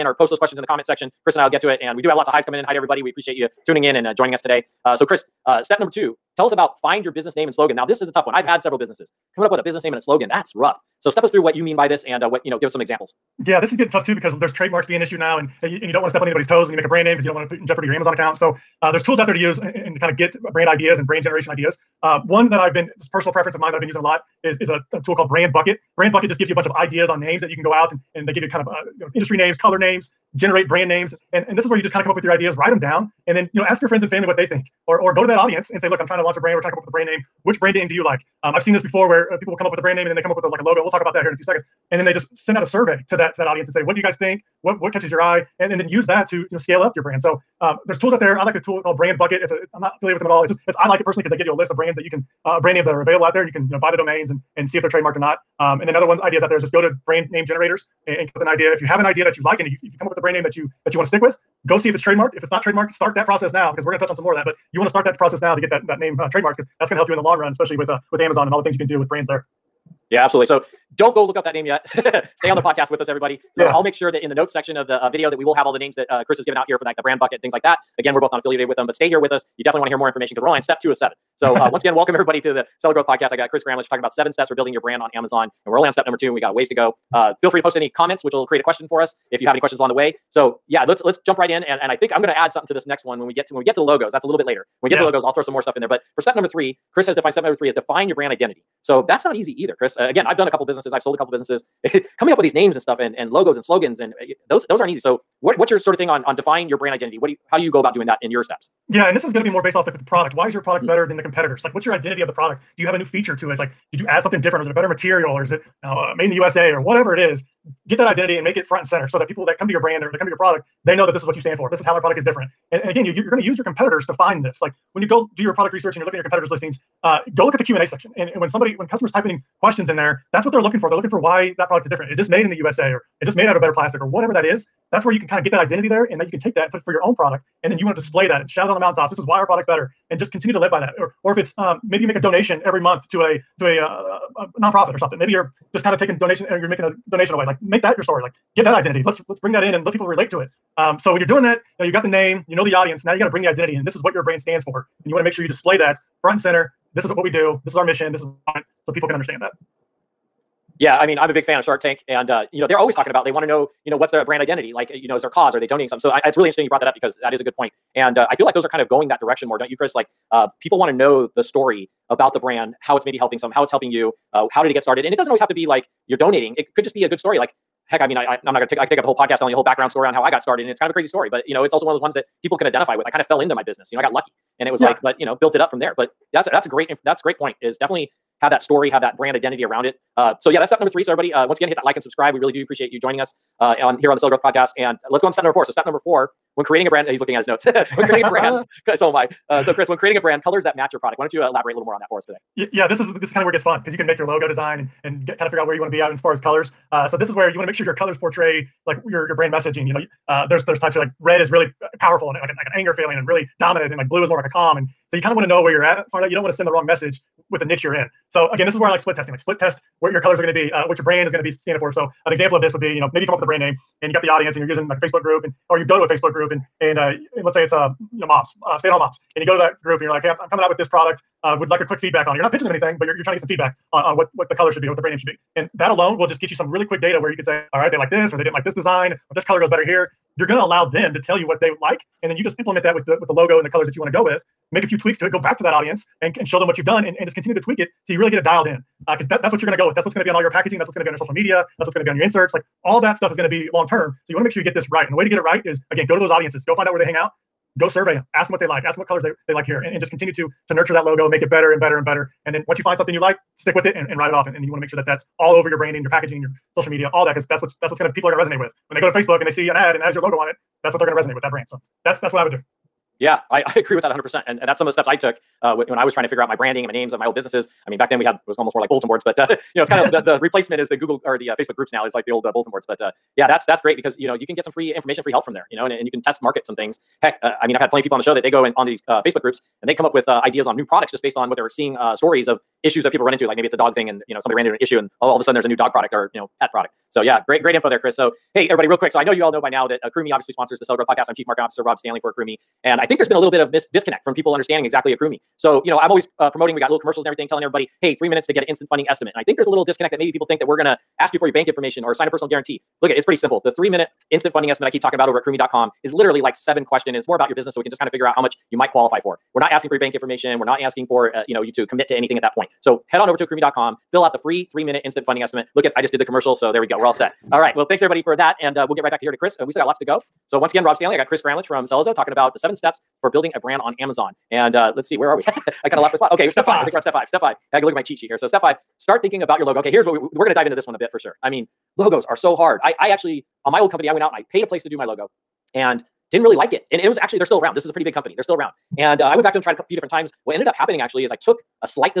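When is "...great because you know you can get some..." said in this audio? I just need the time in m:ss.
4:43.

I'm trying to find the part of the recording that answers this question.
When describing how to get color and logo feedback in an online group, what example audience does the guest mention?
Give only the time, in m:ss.
3:48.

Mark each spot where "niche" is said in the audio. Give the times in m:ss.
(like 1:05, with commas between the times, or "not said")
3:37.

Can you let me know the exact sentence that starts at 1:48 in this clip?
Yeah, and this is going to be more based off like the, the product.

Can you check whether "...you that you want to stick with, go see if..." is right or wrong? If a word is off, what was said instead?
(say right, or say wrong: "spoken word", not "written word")
right.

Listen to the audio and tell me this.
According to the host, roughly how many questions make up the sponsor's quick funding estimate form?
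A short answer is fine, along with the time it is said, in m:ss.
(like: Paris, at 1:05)
7, at 5:16.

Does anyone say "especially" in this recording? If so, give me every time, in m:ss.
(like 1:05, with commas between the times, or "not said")
1:07.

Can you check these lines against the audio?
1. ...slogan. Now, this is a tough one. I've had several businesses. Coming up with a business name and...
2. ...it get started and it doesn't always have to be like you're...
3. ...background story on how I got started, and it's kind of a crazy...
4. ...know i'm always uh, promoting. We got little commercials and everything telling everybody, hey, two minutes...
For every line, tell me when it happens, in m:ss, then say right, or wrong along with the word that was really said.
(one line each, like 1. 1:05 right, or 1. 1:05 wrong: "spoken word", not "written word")
1. 0:07 right
2. 2:54 right
3. 2:59 right
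4. 5:05 wrong: "three", not "two".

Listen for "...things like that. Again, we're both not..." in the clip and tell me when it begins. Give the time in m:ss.
1:17.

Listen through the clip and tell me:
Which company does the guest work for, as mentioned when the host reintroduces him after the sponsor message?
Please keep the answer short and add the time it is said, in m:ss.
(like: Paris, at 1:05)
Sellozo, at 5:31.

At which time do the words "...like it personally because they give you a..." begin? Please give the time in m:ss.
0:50.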